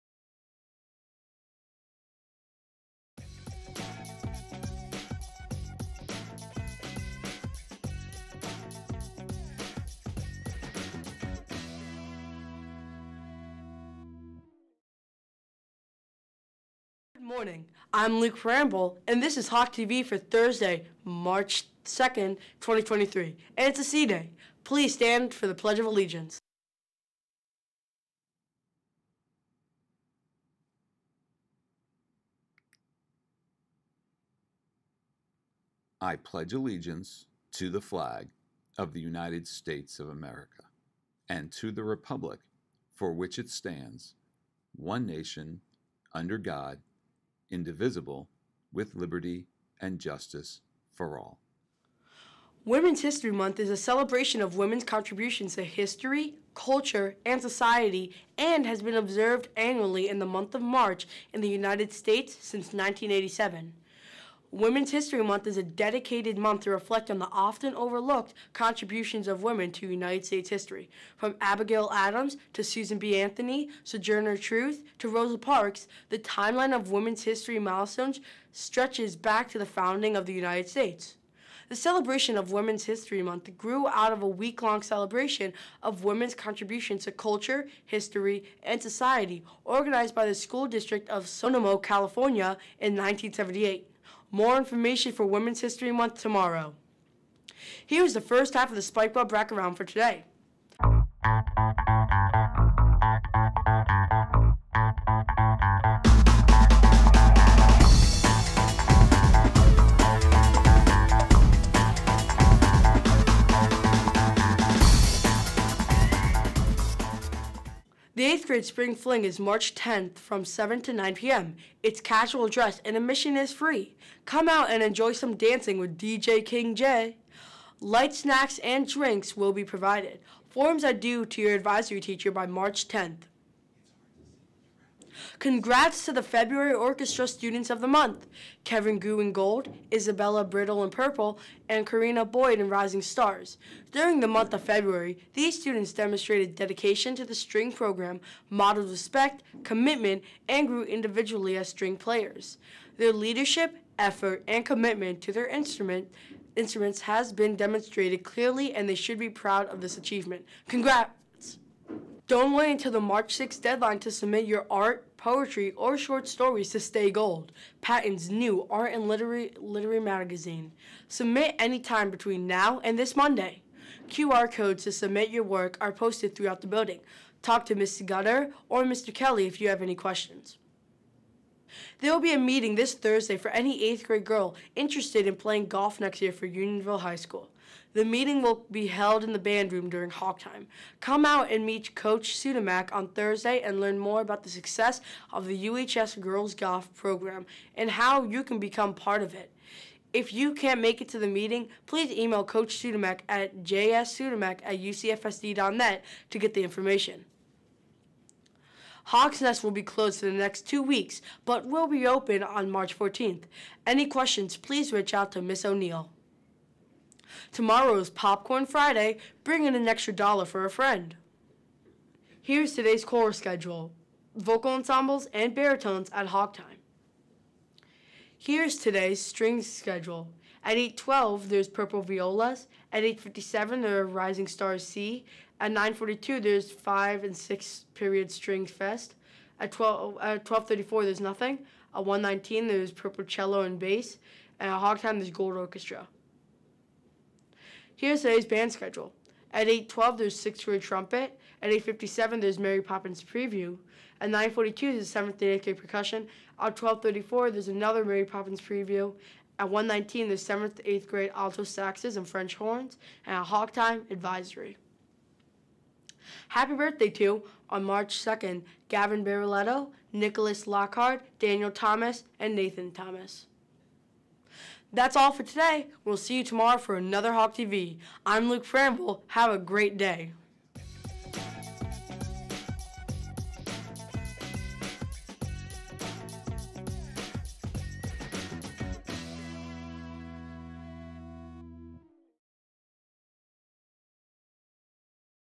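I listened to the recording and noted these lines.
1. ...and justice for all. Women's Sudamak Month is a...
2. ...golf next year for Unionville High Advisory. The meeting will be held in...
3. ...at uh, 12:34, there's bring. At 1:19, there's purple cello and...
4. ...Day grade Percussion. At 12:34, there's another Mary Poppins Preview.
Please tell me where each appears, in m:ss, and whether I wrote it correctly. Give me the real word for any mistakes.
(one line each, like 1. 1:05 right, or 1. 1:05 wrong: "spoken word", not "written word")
1. 0:49 wrong: "History", not "Sudamak"
2. 3:05 wrong: "School", not "Advisory"
3. 4:00 wrong: "nothing", not "bring"
4. 4:15 right.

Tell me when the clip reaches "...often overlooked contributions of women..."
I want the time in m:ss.
1:07.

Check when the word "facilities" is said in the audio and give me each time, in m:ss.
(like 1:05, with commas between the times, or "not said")
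not said.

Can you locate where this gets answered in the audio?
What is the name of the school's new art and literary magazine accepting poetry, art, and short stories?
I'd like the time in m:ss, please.
2:46.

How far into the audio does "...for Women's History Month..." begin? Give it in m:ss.
1:35.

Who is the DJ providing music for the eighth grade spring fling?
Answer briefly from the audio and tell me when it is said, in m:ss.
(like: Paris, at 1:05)
DJ King J, at 2:05.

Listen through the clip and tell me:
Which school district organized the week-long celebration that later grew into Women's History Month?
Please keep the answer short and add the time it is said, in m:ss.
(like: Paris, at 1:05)
Sonoma, California, at 1:31.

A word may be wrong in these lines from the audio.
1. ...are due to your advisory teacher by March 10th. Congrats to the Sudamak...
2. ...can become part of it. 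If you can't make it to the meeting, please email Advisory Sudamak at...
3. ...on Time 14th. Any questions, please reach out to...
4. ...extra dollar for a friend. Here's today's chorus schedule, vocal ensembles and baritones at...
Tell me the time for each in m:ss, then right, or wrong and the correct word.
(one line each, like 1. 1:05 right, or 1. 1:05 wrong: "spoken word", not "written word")
1. 2:10 wrong: "February", not "Sudamak"
2. 3:18 wrong: "Coach", not "Advisory"
3. 3:32 wrong: "March", not "Time"
4. 3:39 right.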